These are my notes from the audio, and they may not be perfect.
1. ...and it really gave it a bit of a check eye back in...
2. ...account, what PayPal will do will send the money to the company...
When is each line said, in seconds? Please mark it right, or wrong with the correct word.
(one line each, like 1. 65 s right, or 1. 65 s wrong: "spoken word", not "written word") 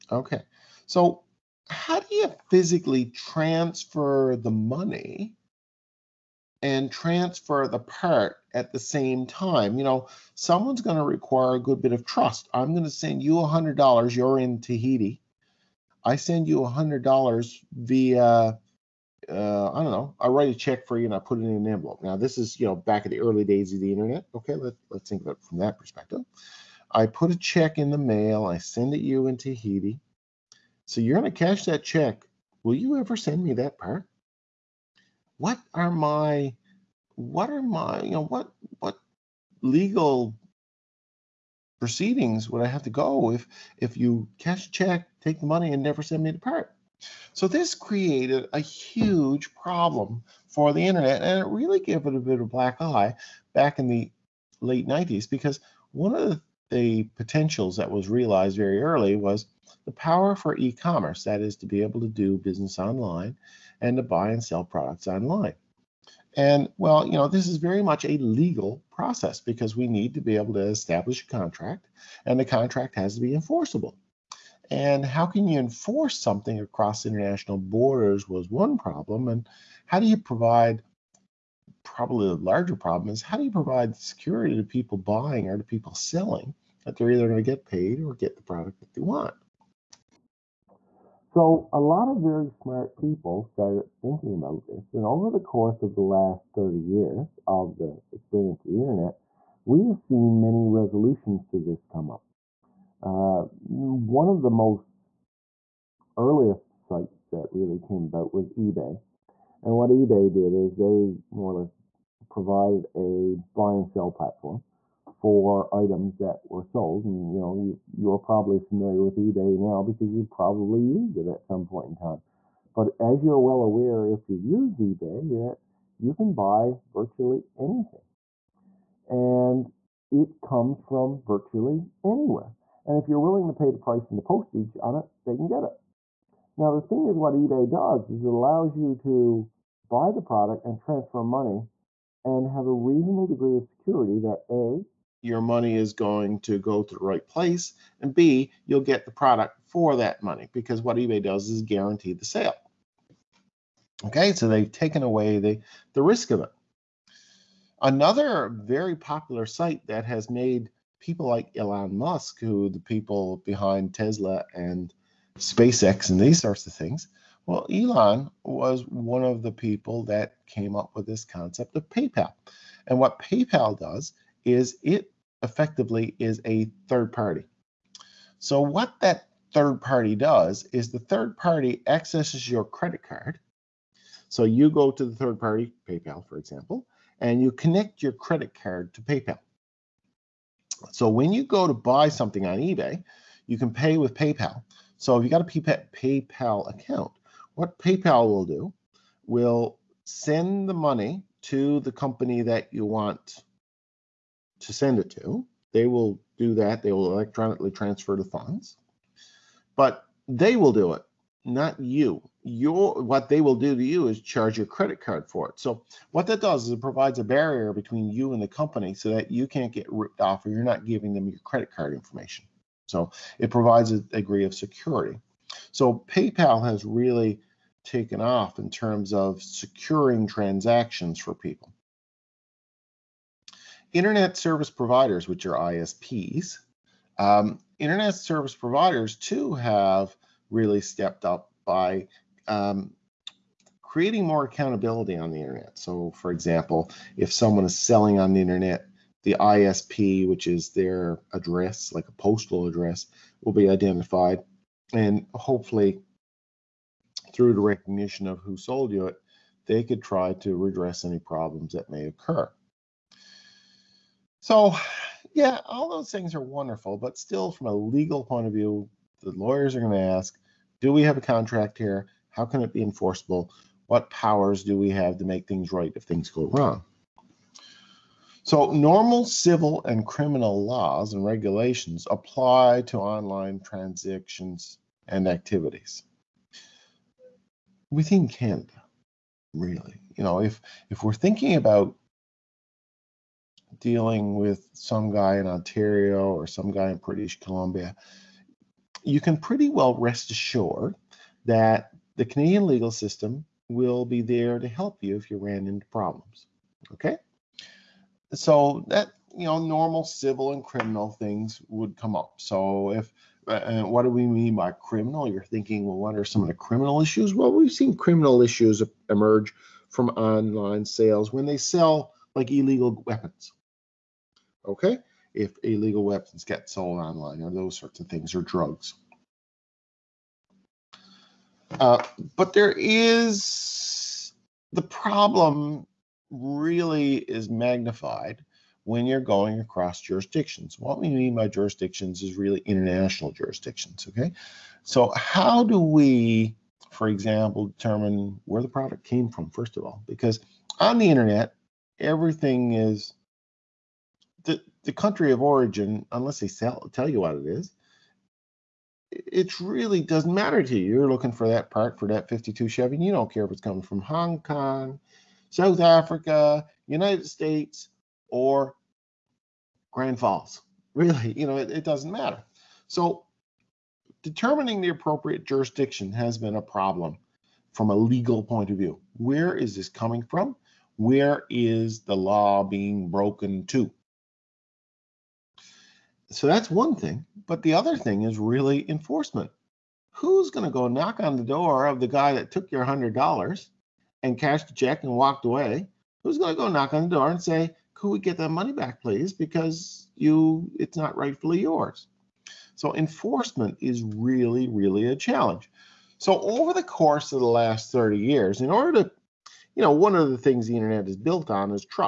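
1. 51 s wrong: "black", not "check"
2. 196 s right.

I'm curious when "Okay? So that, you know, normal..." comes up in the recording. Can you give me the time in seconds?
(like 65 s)
306 s.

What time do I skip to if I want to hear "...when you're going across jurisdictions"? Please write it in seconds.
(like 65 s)
338 s.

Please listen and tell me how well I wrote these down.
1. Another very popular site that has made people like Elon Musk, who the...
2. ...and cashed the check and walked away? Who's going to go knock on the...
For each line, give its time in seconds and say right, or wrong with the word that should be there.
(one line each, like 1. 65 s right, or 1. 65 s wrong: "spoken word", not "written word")
1. 157 s right
2. 394 s right.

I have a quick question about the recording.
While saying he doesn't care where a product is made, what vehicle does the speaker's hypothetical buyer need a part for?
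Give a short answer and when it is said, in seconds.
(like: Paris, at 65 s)
52 Chevy, at 362 s.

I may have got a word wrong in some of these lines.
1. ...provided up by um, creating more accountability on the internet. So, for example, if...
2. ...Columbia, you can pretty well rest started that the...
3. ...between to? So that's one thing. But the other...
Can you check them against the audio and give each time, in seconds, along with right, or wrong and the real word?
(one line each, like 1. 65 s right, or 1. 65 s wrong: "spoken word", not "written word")
1. 240 s wrong: "stepped", not "provided"
2. 297 s wrong: "assured", not "started"
3. 383 s wrong: "broken", not "between".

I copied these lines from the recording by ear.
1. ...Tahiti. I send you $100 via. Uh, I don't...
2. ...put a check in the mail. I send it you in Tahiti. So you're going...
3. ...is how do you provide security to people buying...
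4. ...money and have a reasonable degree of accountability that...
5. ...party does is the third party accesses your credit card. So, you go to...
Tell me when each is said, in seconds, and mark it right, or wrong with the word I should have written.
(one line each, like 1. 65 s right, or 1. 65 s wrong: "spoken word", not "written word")
1. 14 s right
2. 27 s right
3. 83 s right
4. 141 s wrong: "security", not "accountability"
5. 179 s right.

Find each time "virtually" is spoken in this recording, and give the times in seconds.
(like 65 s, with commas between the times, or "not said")
126 s, 131 s.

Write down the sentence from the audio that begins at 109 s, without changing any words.
And what eBay did is they more or less provided a buy and sell platform for items that were sold.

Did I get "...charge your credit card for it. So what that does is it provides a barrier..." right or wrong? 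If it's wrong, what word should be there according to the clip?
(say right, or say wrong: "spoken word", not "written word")
right.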